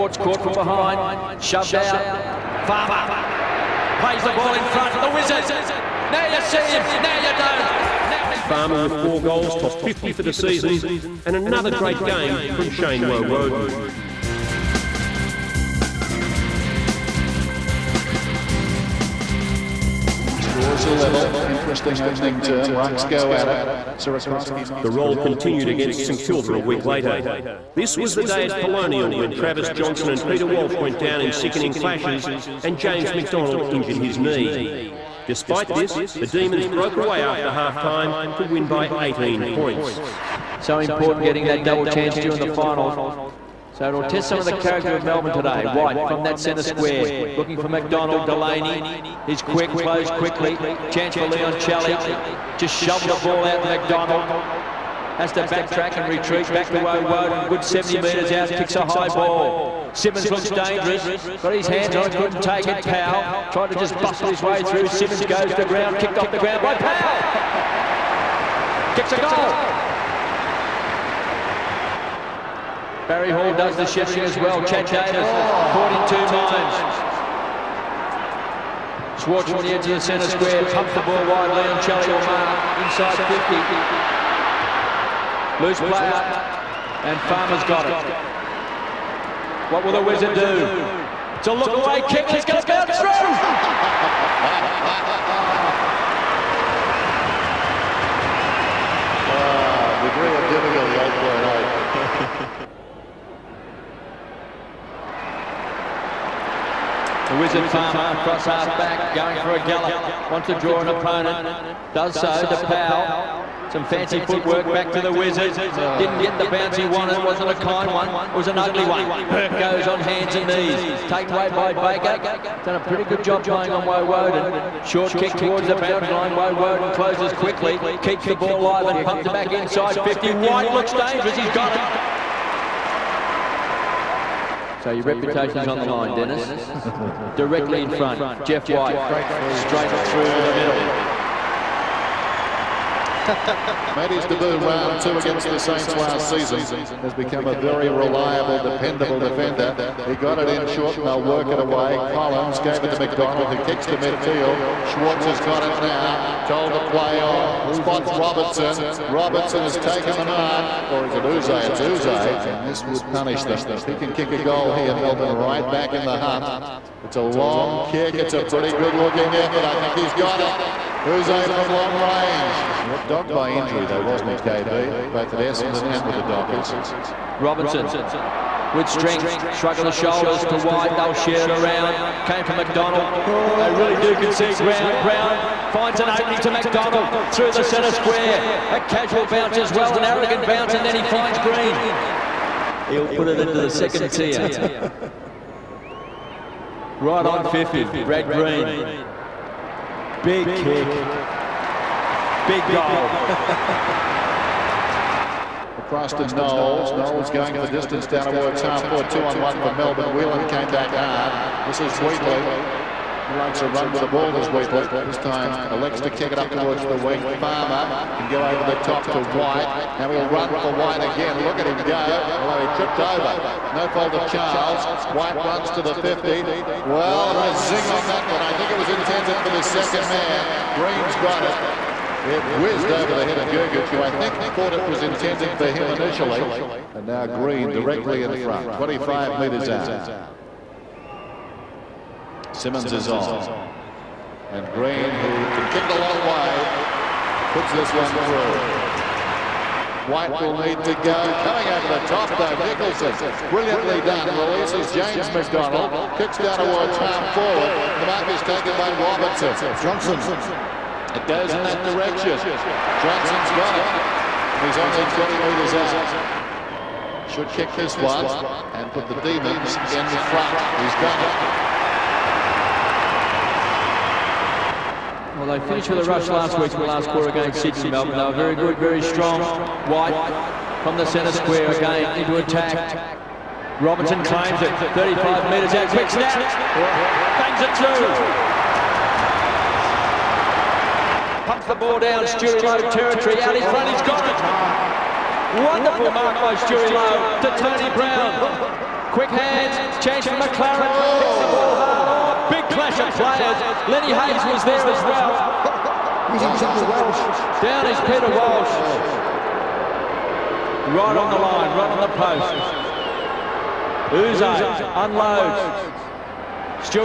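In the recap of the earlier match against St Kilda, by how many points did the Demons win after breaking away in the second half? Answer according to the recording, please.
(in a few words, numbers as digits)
18.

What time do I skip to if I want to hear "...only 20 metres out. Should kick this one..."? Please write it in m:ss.
4:24.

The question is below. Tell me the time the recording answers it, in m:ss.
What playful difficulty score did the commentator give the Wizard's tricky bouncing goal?
1:40.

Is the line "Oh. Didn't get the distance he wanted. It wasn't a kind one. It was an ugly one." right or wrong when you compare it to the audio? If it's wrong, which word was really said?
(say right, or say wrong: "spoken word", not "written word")
wrong: "bounce", not "distance".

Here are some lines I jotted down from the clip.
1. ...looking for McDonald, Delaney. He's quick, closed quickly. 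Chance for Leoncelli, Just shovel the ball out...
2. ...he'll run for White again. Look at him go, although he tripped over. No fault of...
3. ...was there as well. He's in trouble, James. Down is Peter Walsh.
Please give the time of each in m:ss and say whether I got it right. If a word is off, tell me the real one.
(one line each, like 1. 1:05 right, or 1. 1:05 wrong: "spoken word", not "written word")
1. 0:47 right
2. 3:40 right
3. 5:04 wrong: "Welsh", not "James".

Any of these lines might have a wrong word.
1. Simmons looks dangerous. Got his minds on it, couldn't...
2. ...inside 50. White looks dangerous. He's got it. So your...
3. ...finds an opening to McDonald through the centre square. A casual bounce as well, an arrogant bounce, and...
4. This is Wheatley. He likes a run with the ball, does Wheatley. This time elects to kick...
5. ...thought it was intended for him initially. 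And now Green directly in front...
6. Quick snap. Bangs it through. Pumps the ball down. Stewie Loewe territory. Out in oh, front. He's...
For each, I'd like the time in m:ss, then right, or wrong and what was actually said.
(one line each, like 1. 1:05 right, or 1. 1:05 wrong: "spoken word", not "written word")
1. 0:59 wrong: "hands", not "minds"
2. 2:09 right
3. 3:05 right
4. 3:31 right
5. 3:54 right
6. 4:45 right.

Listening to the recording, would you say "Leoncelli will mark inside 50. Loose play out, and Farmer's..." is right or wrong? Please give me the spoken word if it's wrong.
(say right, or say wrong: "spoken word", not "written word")
right.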